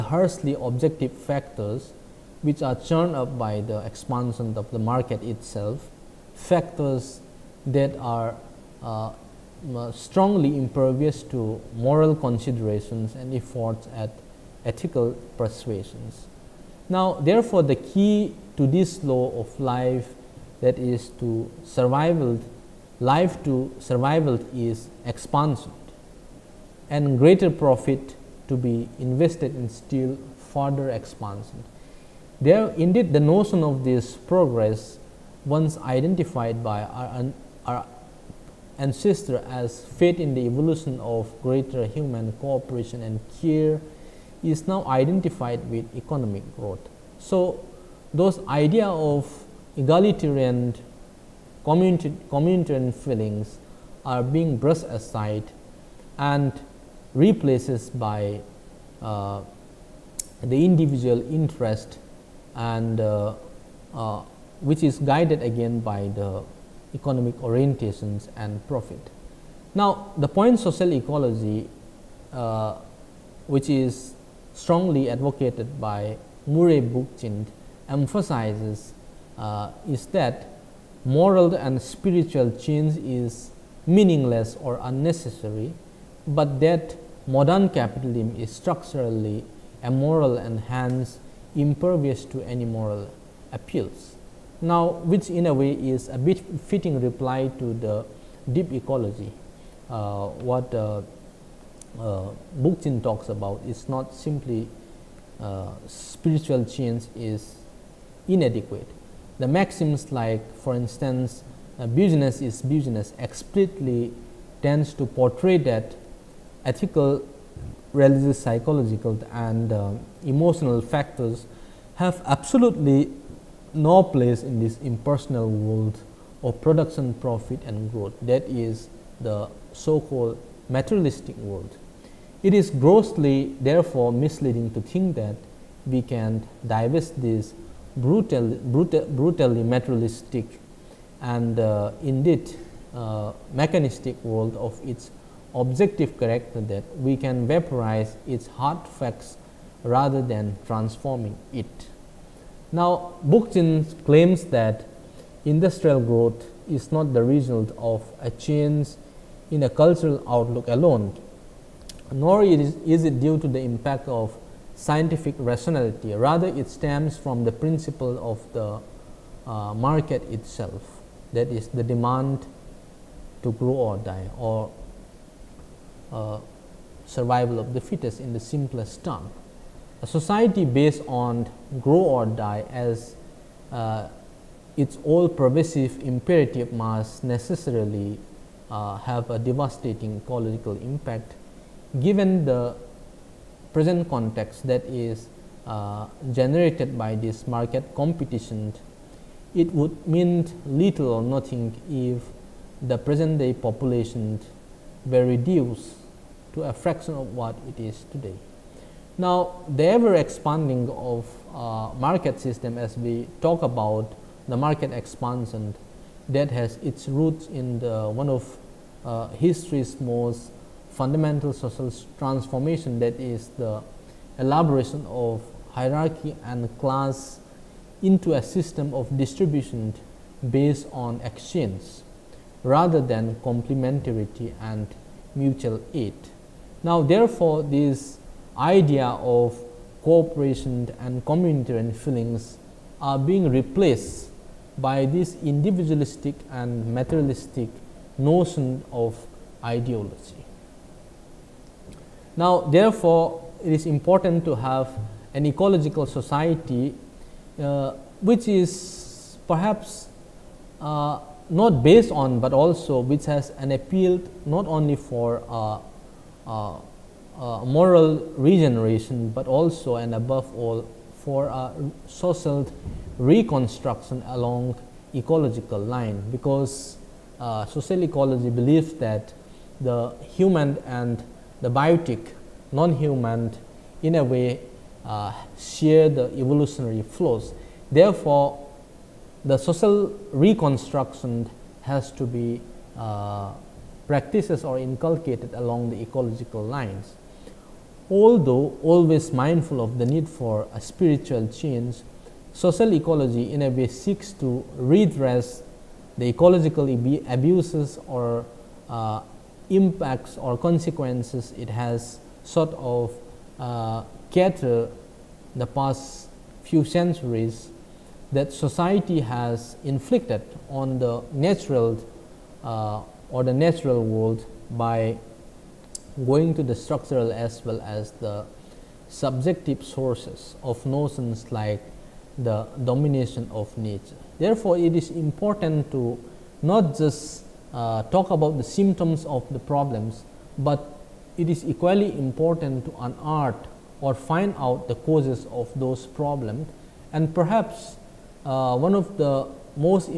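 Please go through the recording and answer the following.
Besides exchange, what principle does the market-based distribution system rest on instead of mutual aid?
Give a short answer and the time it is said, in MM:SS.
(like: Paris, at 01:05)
complementarity, at 03:53.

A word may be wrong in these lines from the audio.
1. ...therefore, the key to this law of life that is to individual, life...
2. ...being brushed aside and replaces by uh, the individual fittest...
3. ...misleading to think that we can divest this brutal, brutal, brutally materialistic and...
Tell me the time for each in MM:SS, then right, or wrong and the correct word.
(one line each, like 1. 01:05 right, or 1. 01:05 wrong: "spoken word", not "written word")
1. 00:17 wrong: "survival", not "individual"
2. 00:54 wrong: "interest", not "fittest"
3. 02:14 right.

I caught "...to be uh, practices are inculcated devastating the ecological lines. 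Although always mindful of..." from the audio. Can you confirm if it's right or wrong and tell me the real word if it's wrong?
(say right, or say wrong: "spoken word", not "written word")
wrong: "along", not "devastating".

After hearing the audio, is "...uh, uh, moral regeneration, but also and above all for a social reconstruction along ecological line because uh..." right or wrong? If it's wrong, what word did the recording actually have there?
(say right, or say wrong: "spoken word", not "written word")
right.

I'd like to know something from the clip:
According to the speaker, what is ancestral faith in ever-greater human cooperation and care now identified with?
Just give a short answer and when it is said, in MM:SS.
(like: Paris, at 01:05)
economic growth, at 00:45.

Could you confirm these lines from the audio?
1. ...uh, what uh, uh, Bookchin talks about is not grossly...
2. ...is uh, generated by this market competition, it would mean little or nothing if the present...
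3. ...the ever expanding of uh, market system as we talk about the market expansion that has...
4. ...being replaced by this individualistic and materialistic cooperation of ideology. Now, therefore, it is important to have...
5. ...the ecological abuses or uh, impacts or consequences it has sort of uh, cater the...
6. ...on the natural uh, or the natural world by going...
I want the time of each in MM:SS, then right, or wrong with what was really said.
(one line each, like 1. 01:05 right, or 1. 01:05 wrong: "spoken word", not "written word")
1. 01:39 wrong: "simply", not "grossly"
2. 03:14 right
3. 03:29 right
4. 04:03 wrong: "notion", not "cooperation"
5. 05:06 right
6. 05:20 right.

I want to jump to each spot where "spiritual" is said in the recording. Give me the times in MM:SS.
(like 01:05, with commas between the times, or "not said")
01:21, 01:45, 05:00.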